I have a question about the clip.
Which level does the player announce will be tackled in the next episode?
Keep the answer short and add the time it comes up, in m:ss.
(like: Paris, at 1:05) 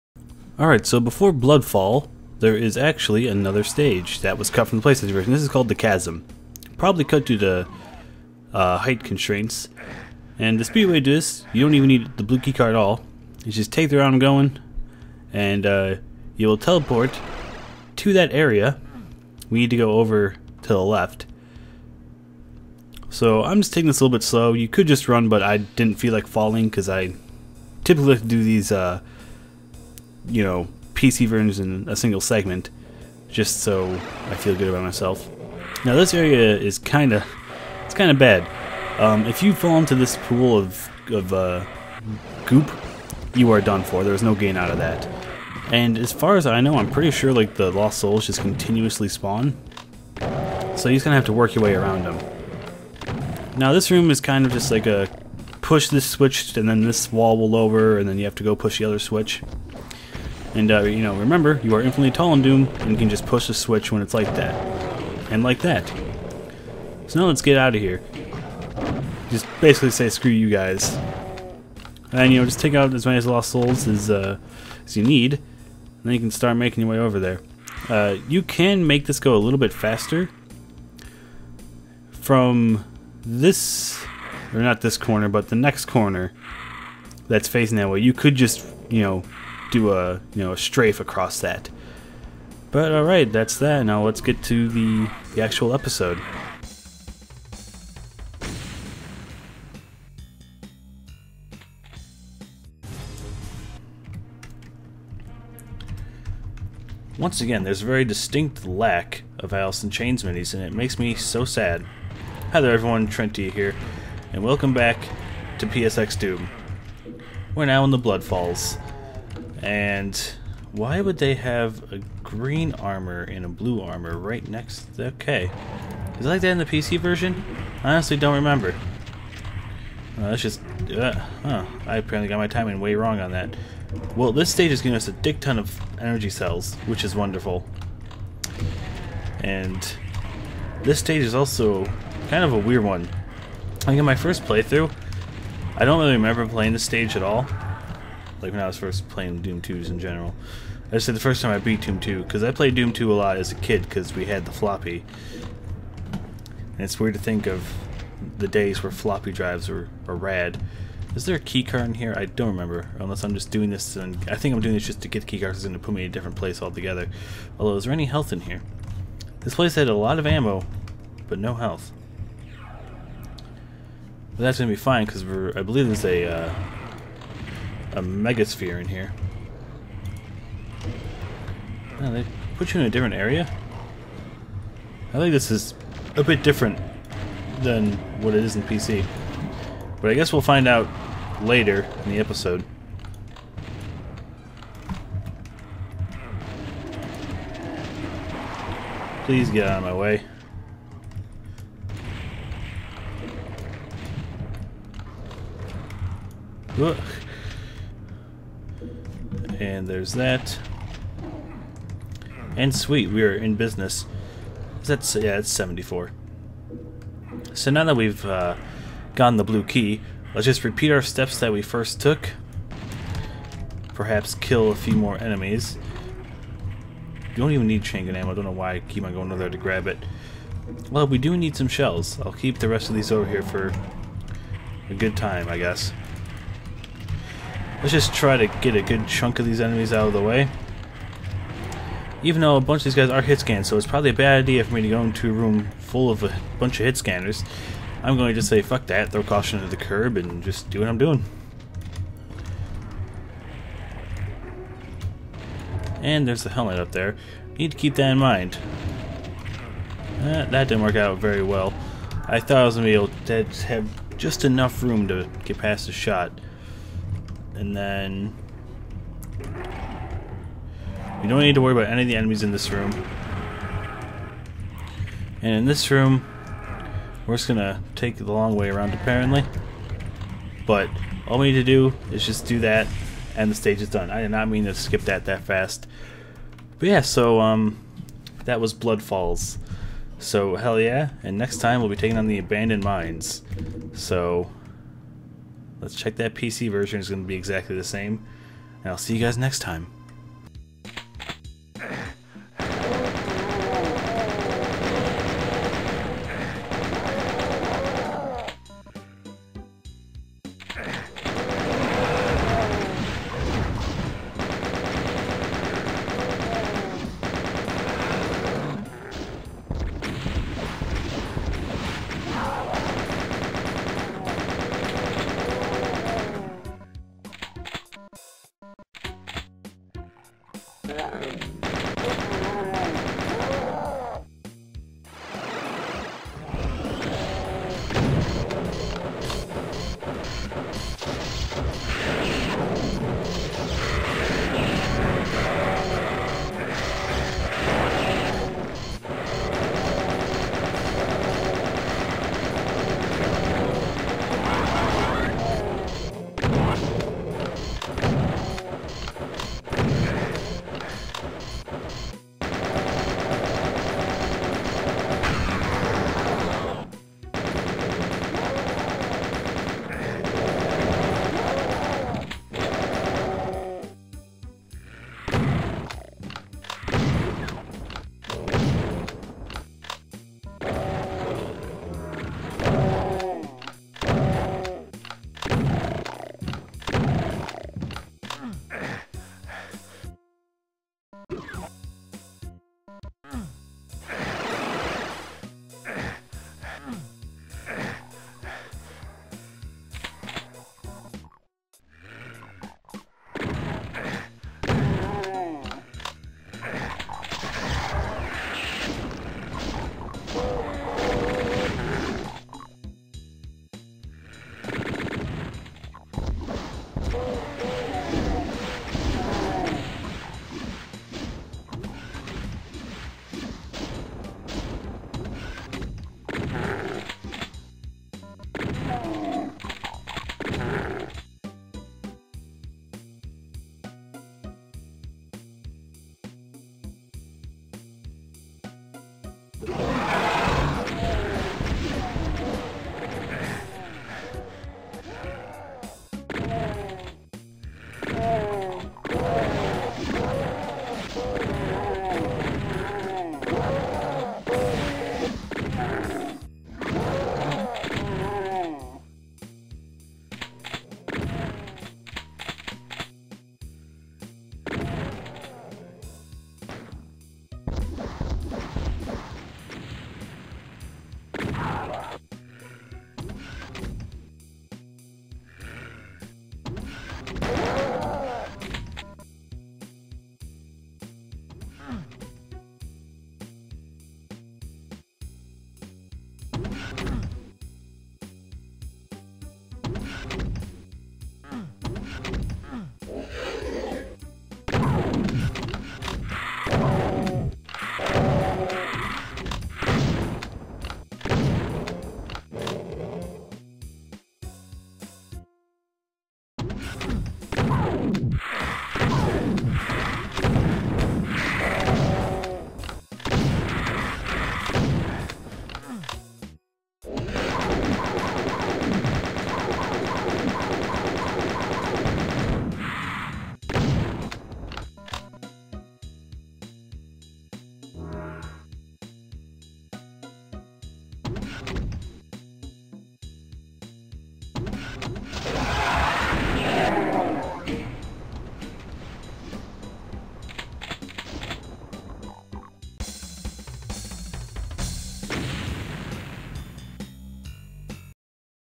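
Abandoned Mines, at 4:52.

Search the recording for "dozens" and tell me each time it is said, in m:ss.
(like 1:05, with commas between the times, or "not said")
not said.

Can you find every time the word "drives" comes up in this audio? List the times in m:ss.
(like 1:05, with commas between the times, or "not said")
2:39.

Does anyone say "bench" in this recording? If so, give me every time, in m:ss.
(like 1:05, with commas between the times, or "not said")
not said.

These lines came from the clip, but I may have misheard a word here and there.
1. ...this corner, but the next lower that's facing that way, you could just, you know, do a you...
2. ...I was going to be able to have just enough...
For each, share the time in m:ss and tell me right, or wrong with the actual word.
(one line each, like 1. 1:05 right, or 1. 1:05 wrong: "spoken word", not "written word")
1. 1:24 wrong: "corner", not "lower"
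2. 4:22 right.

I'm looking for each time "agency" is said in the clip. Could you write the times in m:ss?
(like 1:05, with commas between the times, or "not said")
not said.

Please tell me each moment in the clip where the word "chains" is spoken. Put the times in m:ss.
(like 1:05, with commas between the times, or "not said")
1:49, 3:47.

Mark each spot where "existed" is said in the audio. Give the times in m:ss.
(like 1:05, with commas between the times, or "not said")
not said.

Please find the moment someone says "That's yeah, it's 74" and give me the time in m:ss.
3:34.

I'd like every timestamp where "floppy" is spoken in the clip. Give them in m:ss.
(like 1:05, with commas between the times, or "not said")
2:34, 2:38.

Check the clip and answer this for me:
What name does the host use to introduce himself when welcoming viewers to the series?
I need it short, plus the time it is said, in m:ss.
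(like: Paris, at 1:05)
Trenty, at 1:53.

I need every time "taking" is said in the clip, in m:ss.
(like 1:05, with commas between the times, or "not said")
0:23, 4:51.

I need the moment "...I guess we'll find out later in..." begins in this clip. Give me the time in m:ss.
3:10.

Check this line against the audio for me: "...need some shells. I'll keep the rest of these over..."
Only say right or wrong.
right.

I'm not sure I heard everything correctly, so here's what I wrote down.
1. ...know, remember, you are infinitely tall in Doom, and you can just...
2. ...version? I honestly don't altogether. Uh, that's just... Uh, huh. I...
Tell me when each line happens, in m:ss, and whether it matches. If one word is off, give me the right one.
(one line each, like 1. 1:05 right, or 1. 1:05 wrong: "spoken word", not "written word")
1. 1:01 right
2. 2:06 wrong: "remember", not "altogether".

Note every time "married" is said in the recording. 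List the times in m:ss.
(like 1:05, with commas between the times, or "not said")
not said.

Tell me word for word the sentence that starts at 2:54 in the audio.
But that's going to be fine, because I believe there's a...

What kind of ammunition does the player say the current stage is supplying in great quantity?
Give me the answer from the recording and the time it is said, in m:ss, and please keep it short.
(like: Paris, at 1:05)
Energy cells, at 2:15.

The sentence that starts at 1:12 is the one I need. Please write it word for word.
And, you know, just take out as many lost souls as, uh, as you need.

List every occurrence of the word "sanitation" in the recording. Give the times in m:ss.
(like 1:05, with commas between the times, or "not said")
not said.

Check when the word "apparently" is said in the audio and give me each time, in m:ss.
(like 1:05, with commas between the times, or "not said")
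2:11, 4:38.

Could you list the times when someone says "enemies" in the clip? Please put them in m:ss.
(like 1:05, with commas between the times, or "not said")
3:45, 3:59, 4:32.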